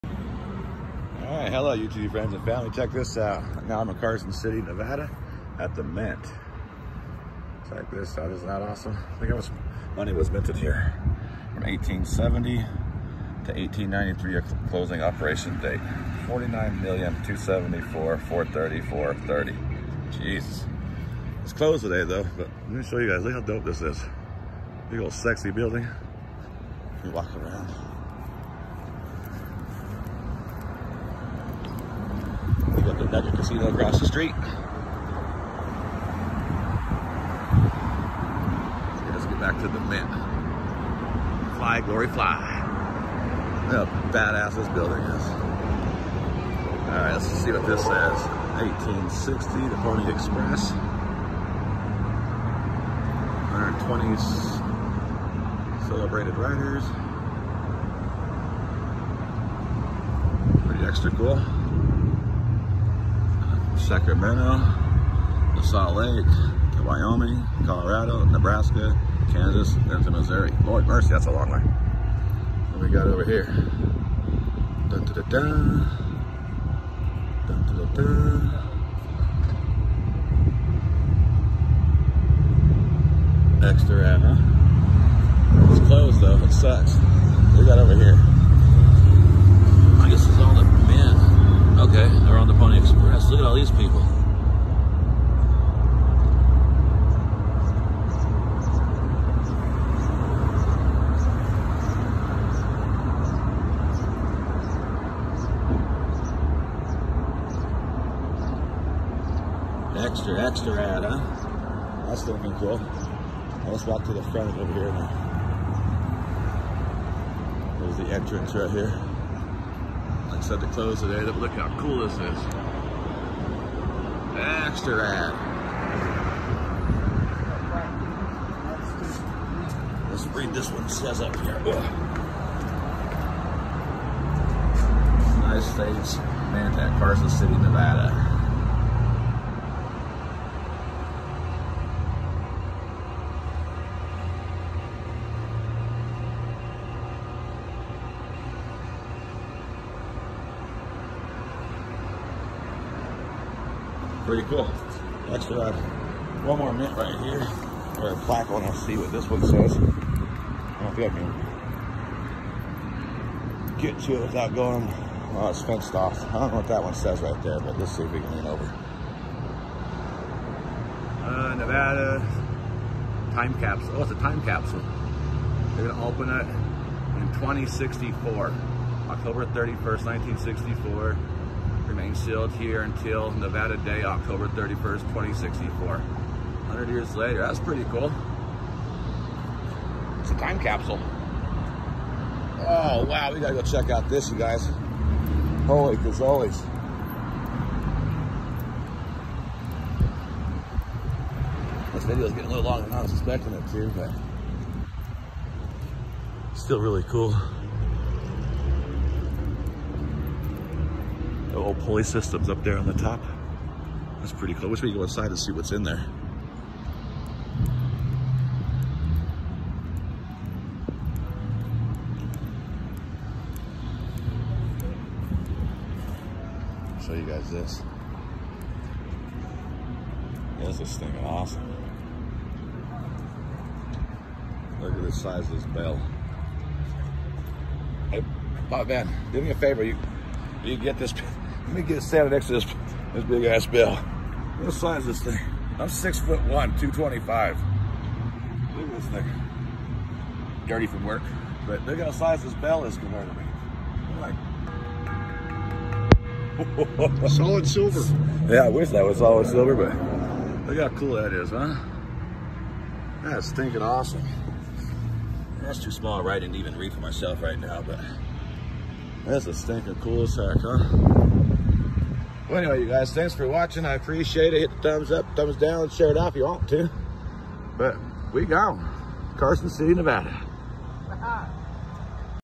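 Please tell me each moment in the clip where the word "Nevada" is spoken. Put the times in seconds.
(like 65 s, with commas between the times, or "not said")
4 s, 137 s, 171 s, 183 s, 279 s.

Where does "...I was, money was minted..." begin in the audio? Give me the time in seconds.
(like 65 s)
9 s.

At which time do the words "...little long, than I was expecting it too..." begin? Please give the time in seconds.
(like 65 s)
202 s.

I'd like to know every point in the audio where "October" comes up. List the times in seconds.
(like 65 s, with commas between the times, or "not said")
179 s, 184 s.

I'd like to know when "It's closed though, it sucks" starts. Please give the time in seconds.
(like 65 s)
85 s.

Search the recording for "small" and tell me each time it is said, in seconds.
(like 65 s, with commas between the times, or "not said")
265 s.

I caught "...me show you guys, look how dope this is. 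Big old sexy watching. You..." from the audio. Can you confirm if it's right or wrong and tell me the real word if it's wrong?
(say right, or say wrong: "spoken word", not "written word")
wrong: "building", not "watching".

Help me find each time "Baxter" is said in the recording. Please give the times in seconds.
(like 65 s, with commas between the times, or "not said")
124 s.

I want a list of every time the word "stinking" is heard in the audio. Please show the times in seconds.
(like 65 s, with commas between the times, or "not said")
230 s, 263 s, 269 s.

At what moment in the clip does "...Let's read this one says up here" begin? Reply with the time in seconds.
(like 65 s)
130 s.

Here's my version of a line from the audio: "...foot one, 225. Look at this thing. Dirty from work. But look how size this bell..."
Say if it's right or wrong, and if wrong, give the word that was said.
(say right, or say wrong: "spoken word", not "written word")
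right.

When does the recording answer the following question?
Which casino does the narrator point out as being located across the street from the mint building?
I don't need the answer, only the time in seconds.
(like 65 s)
33 s.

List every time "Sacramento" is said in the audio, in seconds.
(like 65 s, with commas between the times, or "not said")
63 s.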